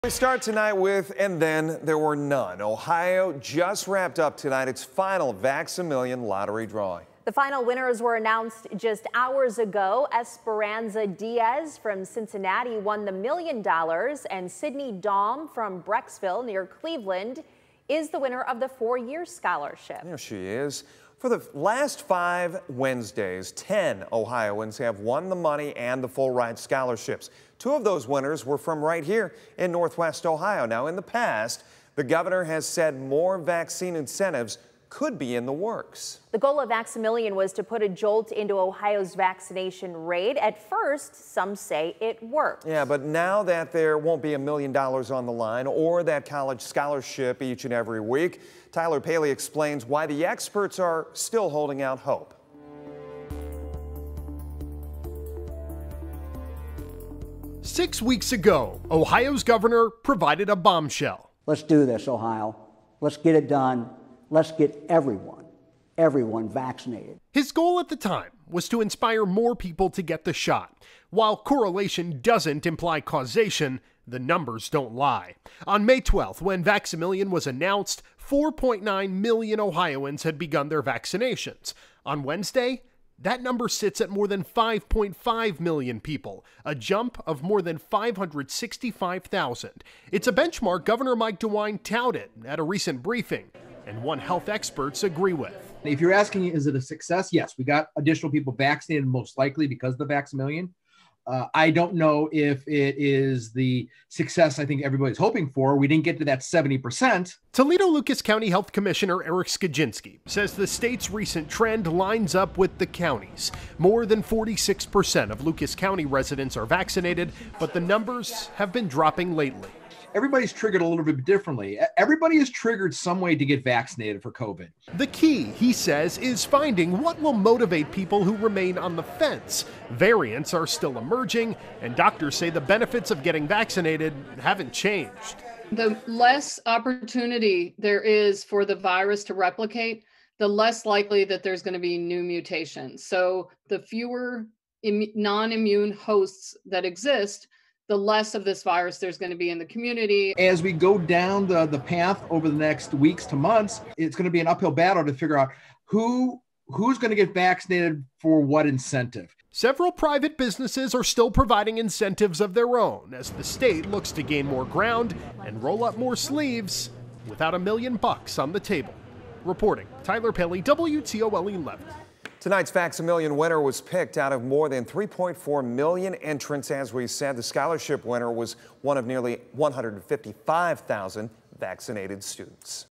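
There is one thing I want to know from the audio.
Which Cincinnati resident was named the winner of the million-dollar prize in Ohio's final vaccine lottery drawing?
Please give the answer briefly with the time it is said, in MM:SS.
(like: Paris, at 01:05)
Esperanza Diaz, at 00:10.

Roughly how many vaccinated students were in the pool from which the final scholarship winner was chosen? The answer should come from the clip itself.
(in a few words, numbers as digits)
155,000.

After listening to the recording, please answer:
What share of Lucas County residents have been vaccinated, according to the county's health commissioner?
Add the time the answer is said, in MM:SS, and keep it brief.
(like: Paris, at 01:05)
More than 46%, at 01:53.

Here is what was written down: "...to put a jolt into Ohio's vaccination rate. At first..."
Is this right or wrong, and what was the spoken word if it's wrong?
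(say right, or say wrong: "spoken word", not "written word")
right.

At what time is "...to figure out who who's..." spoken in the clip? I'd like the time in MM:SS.
02:35.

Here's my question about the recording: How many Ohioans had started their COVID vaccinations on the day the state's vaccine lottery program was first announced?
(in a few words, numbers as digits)
4.9 million.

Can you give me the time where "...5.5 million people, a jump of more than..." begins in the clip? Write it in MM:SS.
01:24.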